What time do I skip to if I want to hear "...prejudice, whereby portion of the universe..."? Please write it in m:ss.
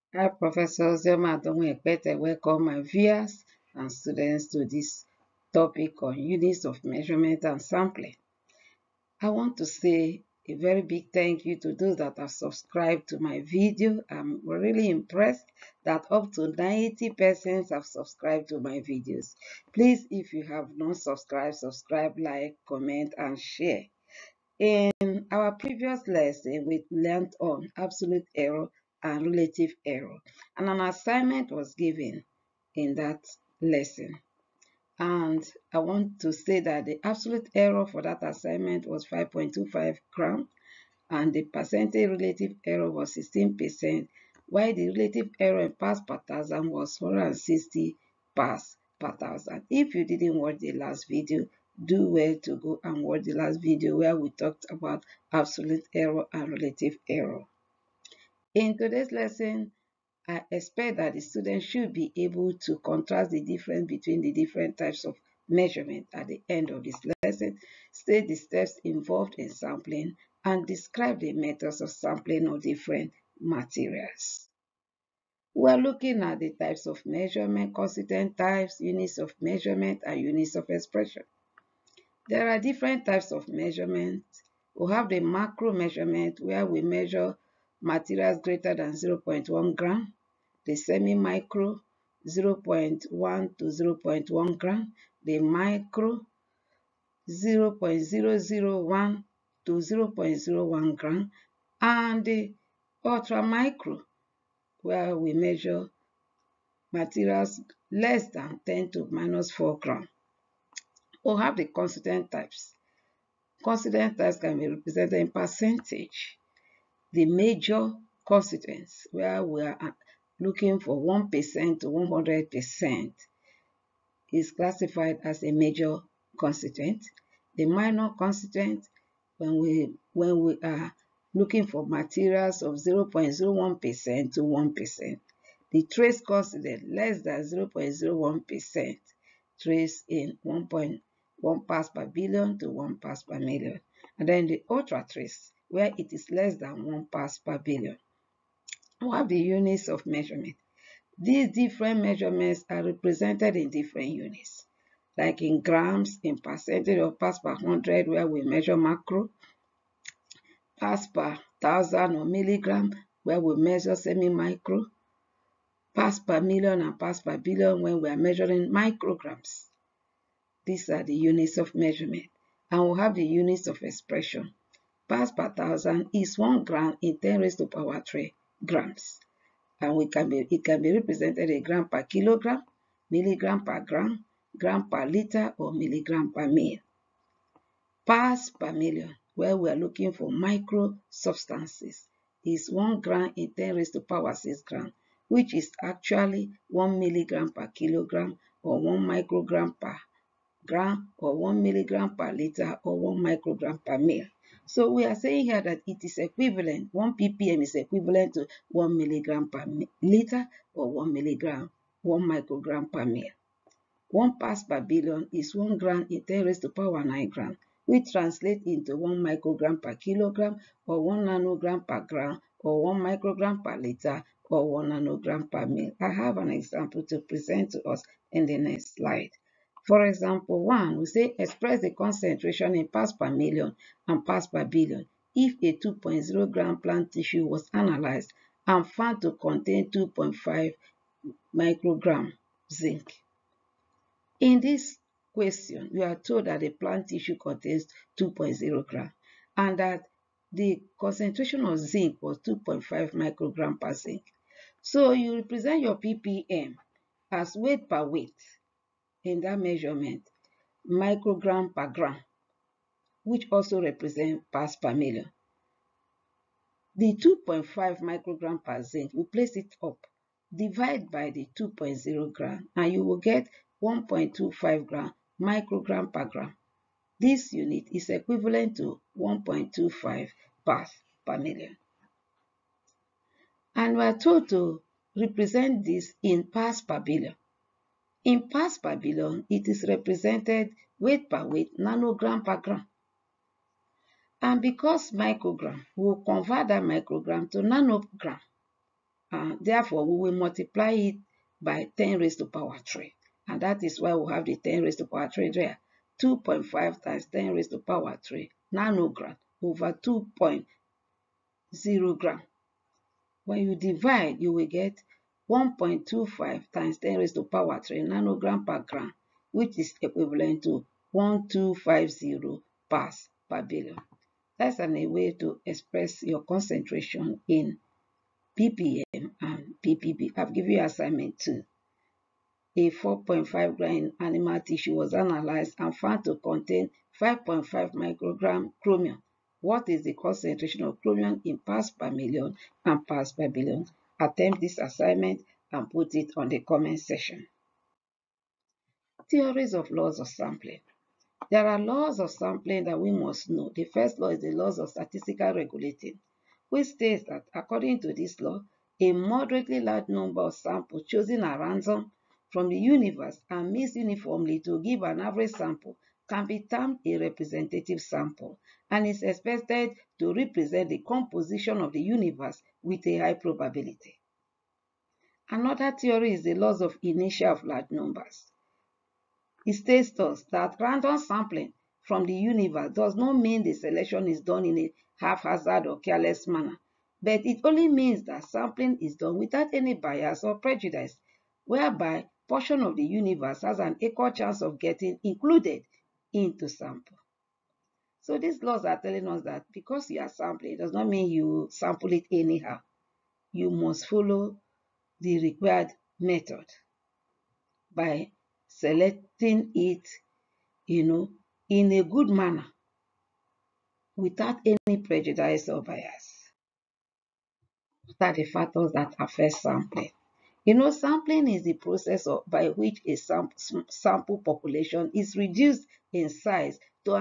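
6:30.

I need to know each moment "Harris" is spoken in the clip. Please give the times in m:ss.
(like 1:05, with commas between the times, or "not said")
not said.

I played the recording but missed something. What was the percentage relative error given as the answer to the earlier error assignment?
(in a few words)
16%.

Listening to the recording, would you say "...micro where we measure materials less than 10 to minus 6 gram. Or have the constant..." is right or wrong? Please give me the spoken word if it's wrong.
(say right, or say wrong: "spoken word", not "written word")
wrong: "4", not "6".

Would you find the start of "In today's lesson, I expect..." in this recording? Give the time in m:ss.
0:58.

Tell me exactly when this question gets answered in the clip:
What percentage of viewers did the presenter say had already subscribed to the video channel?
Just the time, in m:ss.
0:16.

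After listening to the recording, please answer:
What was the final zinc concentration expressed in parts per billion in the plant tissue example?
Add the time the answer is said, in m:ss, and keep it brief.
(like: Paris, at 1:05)
1250, at 5:21.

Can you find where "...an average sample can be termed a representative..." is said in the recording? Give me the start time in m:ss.
6:05.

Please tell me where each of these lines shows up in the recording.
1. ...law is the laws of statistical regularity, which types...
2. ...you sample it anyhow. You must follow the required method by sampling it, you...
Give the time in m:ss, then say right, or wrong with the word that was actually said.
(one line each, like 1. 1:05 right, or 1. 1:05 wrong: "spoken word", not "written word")
1. 5:54 wrong: "states", not "types"
2. 6:41 wrong: "selecting", not "sampling".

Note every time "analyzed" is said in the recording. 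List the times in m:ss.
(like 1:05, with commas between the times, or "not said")
3:57, 5:35.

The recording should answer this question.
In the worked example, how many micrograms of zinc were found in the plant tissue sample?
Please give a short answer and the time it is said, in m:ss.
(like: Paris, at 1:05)
2.5 microgram, at 3:59.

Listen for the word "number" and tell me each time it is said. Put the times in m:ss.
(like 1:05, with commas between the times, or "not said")
6:00, 6:17.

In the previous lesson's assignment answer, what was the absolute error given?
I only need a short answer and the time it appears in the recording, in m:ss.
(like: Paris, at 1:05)
5.25 gram, at 0:39.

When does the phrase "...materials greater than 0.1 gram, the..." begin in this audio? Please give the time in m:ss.
1:27.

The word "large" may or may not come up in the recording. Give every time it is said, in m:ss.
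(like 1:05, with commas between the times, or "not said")
5:59, 6:17.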